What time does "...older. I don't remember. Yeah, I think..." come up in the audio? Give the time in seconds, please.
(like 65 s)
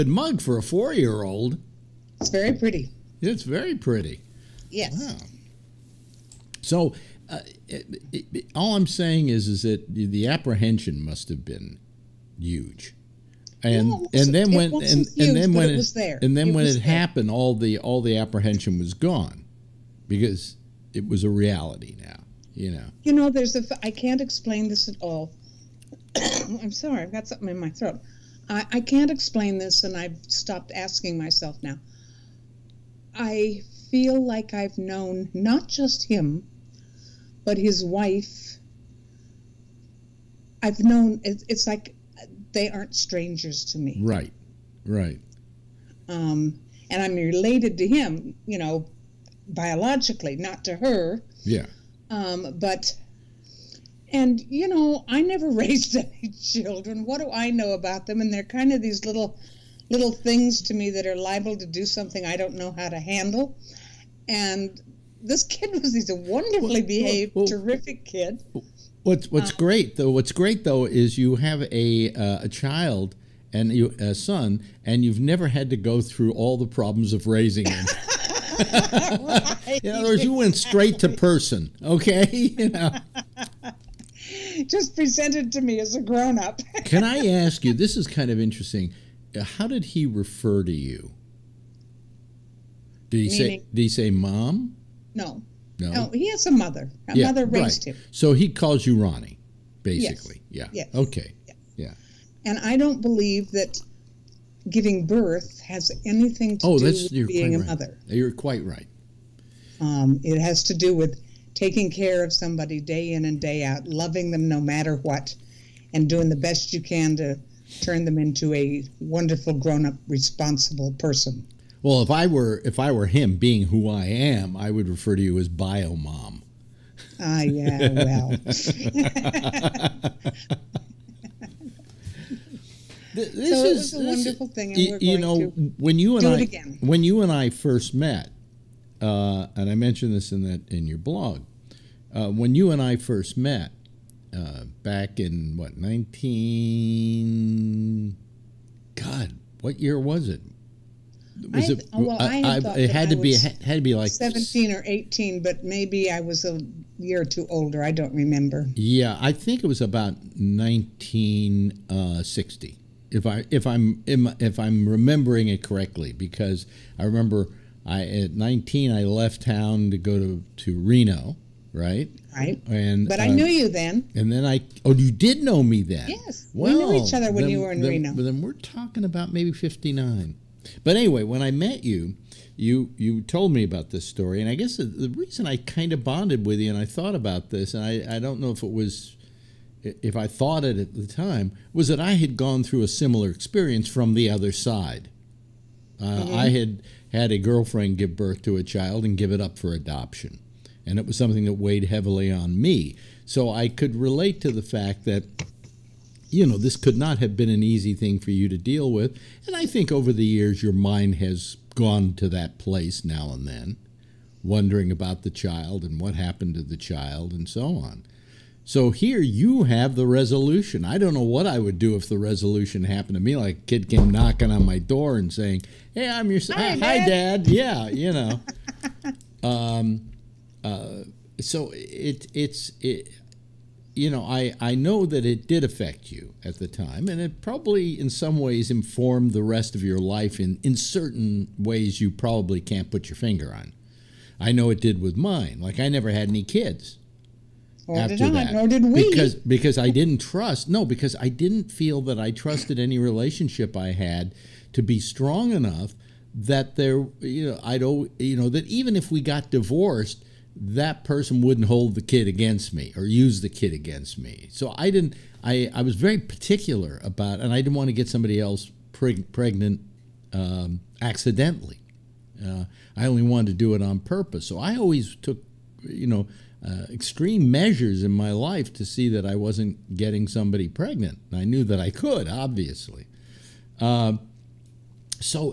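157 s.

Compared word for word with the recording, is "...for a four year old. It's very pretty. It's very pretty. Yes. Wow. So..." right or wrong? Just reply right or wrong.
right.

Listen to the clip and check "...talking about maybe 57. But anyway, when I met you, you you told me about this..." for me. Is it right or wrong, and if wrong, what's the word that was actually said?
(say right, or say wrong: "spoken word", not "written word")
wrong: "59", not "57".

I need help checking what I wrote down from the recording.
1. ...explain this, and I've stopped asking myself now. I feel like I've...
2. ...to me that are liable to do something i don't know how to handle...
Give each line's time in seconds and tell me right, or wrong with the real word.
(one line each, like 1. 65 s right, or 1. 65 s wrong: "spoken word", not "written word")
1. 29 s right
2. 60 s right.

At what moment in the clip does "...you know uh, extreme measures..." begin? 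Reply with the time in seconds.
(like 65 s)
275 s.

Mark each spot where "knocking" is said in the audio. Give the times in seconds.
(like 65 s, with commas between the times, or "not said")
224 s.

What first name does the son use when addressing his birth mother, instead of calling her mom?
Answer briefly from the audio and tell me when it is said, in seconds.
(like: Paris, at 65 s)
Ronni, at 98 s.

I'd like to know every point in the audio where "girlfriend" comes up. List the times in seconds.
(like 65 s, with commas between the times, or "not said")
197 s.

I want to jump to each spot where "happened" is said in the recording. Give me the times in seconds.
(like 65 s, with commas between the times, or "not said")
16 s, 216 s, 222 s.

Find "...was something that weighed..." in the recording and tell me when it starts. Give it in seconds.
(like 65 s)
201 s.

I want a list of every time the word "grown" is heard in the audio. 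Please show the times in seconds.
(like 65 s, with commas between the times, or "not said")
86 s, 119 s.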